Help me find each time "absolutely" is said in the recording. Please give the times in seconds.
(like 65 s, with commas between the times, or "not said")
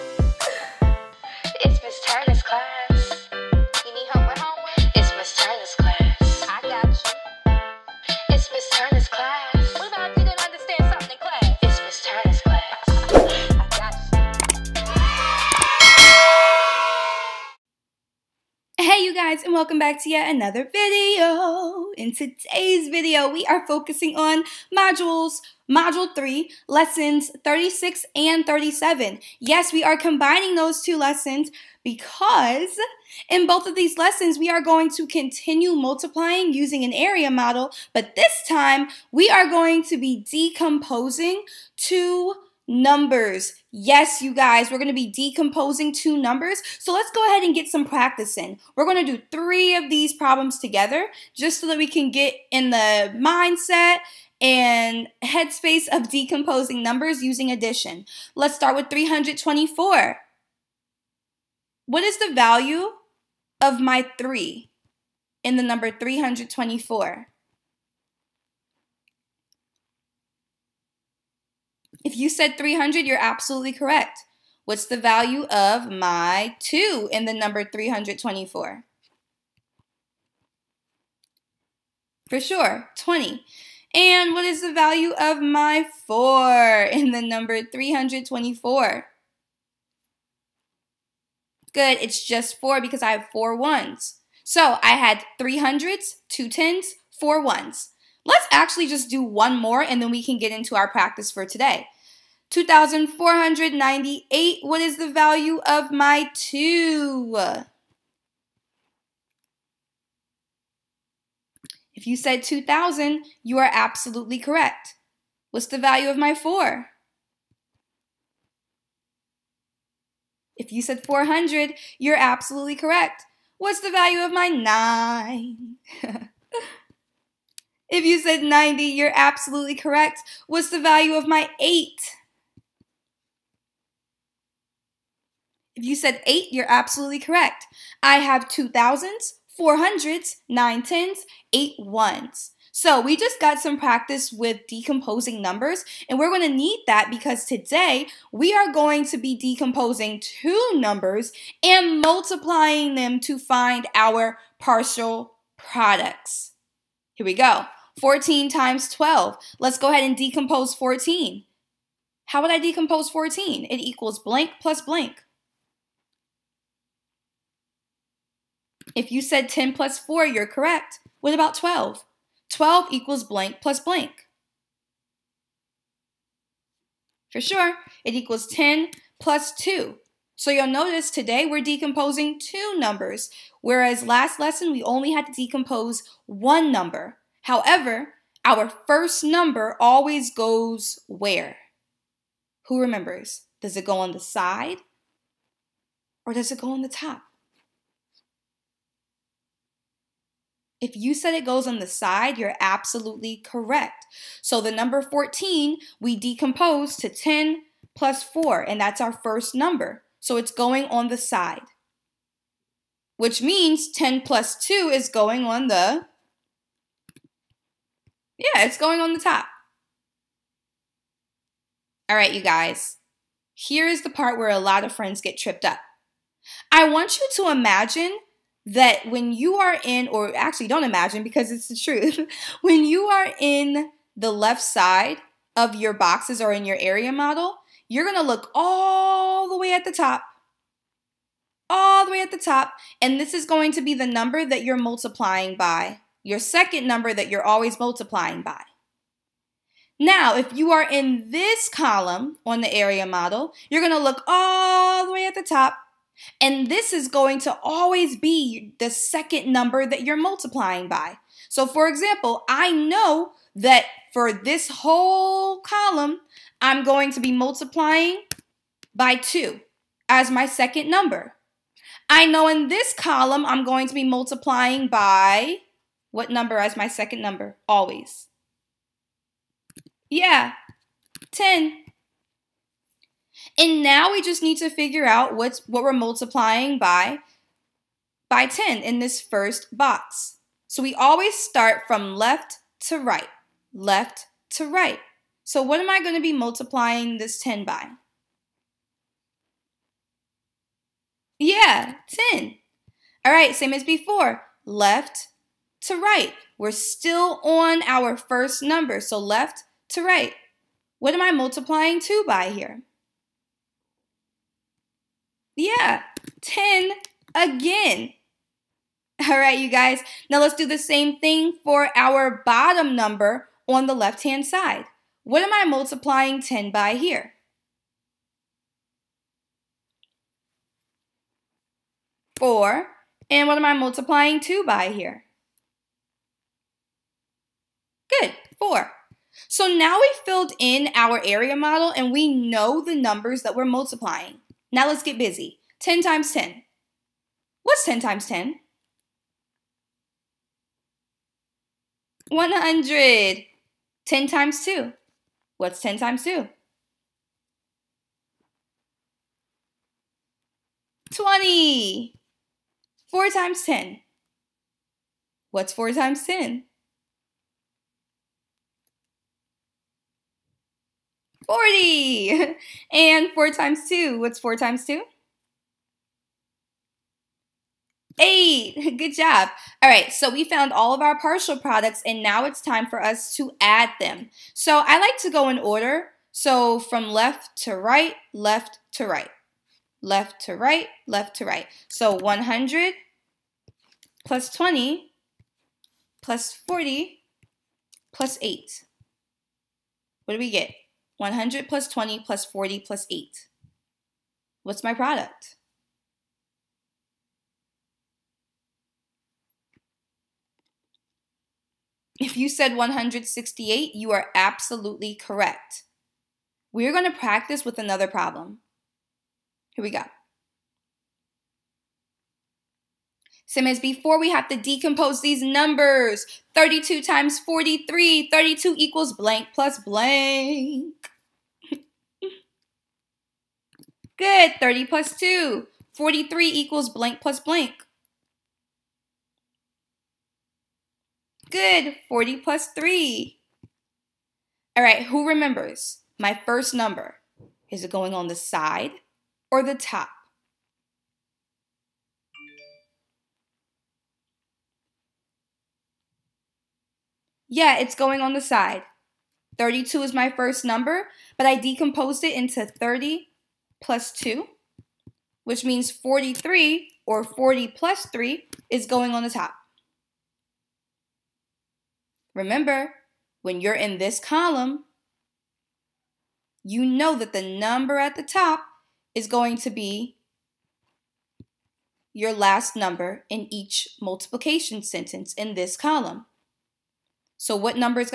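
73 s, 113 s, 122 s, 129 s, 136 s, 202 s, 414 s.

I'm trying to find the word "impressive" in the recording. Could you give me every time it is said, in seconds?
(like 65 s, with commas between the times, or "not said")
not said.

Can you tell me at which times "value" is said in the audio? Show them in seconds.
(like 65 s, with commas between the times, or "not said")
62 s, 74 s, 84 s, 105 s, 115 s, 123 s, 130 s.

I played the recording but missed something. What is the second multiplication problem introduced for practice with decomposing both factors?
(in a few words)
32 times 43.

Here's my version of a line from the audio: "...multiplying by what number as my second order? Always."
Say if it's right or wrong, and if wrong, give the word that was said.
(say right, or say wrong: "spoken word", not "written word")
wrong: "number", not "order".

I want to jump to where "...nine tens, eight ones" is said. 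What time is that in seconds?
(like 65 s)
140 s.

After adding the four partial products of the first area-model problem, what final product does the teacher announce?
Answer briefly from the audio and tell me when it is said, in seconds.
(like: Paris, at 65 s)
168, at 412 s.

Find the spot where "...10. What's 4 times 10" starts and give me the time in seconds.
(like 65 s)
363 s.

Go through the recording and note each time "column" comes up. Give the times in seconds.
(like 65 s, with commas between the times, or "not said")
251 s, 265 s, 272 s, 474 s, 485 s.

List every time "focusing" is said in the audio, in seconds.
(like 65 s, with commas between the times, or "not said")
23 s.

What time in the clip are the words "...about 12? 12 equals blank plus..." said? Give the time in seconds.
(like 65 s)
171 s.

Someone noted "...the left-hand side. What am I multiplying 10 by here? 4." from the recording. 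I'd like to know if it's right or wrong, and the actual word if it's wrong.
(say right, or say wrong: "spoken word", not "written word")
right.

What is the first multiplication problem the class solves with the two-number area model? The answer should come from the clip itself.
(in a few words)
14 times 12.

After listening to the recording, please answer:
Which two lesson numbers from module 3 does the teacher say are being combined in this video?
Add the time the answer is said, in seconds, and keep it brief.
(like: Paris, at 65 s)
36 and 37, at 26 s.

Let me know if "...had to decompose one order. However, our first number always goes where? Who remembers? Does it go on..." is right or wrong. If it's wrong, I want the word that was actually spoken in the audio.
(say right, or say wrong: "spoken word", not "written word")
wrong: "number", not "order".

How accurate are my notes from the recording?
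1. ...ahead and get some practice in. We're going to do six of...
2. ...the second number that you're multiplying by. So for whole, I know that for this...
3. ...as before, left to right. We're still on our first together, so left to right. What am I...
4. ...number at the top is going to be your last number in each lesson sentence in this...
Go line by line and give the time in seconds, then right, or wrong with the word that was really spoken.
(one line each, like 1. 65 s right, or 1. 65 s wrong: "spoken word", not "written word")
1. 47 s wrong: "three", not "six"
2. 258 s wrong: "example", not "whole"
3. 303 s wrong: "number", not "together"
4. 477 s wrong: "multiplication", not "lesson".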